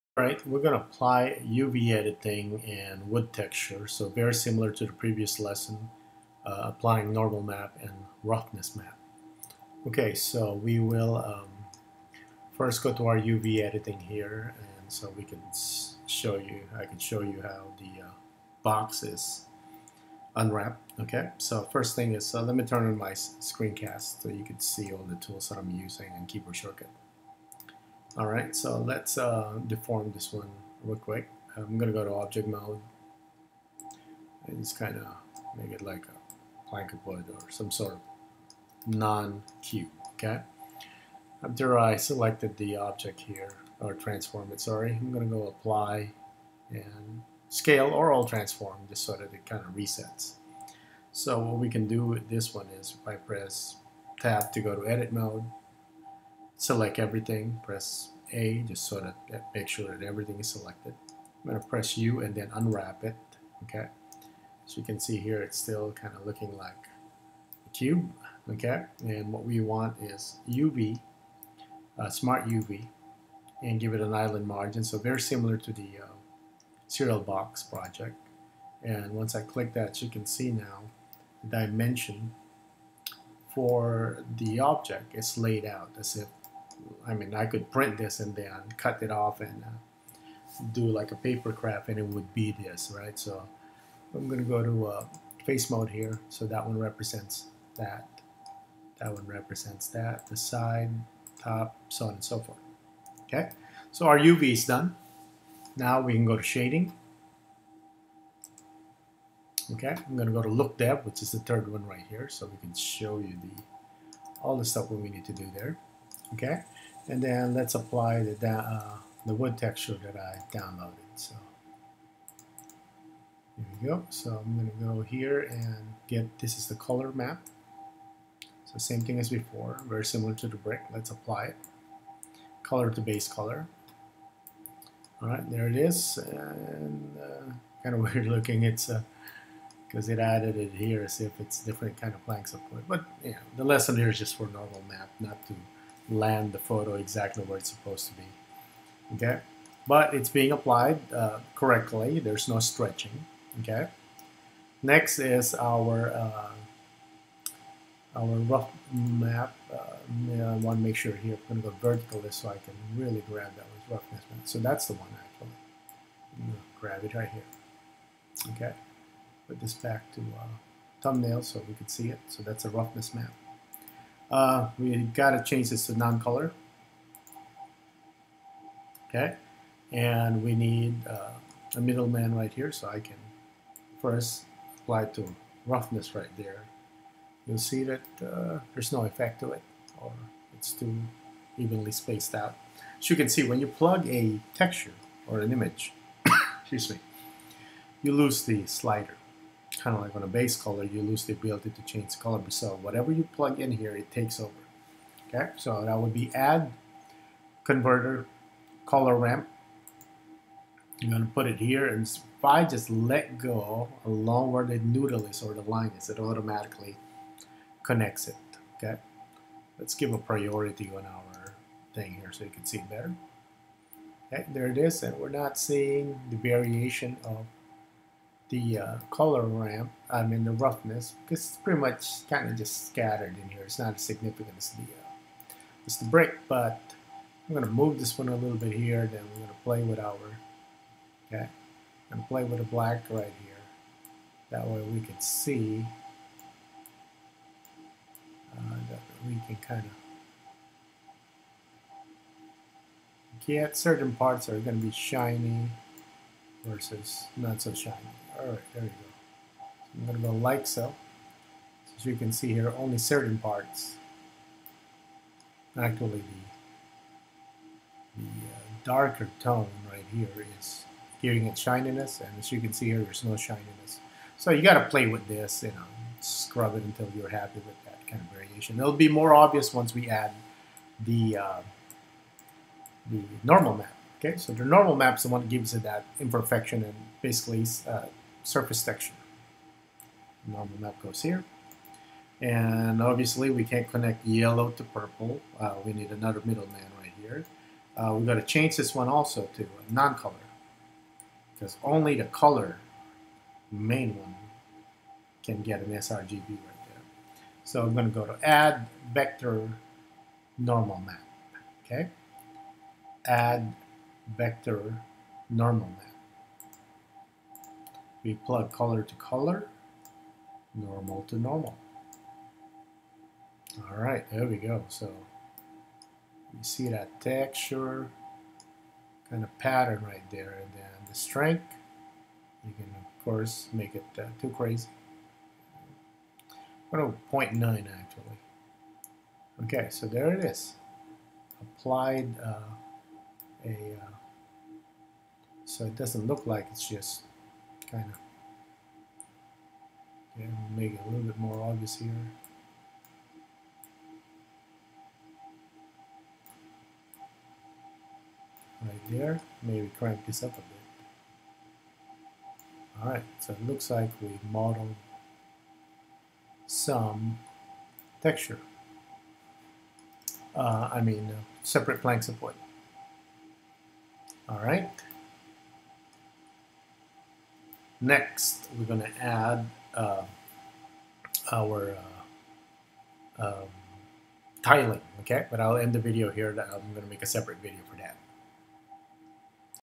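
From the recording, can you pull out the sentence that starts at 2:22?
But yeah, the lesson here is just for normal map, not to land the photo exactly where it's supposed to be.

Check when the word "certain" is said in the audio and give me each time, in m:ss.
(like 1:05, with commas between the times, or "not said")
4:13, 4:22.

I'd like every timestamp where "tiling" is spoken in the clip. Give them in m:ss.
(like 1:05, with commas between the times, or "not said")
6:24.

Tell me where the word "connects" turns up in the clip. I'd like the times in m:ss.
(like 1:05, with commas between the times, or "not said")
3:37, 4:53.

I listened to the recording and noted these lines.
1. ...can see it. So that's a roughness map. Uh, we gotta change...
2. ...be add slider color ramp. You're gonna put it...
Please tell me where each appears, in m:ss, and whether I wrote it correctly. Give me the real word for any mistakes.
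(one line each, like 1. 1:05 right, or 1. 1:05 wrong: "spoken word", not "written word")
1. 2:51 right
2. 3:26 wrong: "converter", not "slider".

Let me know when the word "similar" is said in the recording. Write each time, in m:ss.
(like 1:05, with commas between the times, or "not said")
0:04, 1:15, 2:10.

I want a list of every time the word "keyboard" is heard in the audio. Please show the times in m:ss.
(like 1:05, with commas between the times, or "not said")
0:26.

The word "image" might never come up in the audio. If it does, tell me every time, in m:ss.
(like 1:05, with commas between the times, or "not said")
3:15.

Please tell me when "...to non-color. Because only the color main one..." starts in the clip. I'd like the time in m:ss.
4:59.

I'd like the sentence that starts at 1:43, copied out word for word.
Okay, so our UV is done.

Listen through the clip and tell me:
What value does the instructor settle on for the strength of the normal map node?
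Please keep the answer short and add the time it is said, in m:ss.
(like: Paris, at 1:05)
0.9, at 5:37.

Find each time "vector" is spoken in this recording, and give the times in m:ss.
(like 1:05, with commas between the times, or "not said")
5:09, 5:14.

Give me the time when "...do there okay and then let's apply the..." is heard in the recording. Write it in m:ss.
1:55.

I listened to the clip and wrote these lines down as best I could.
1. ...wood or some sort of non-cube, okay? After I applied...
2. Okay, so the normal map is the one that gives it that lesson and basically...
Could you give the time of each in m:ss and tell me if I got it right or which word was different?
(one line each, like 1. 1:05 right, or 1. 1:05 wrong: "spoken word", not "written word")
1. 0:37 wrong: "selected", not "applied"
2. 4:44 wrong: "imperfection", not "lesson".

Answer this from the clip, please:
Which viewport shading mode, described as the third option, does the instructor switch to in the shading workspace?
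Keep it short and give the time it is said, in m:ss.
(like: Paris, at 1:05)
LookDev, at 1:50.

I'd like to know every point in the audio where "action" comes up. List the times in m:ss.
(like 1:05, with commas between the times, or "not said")
not said.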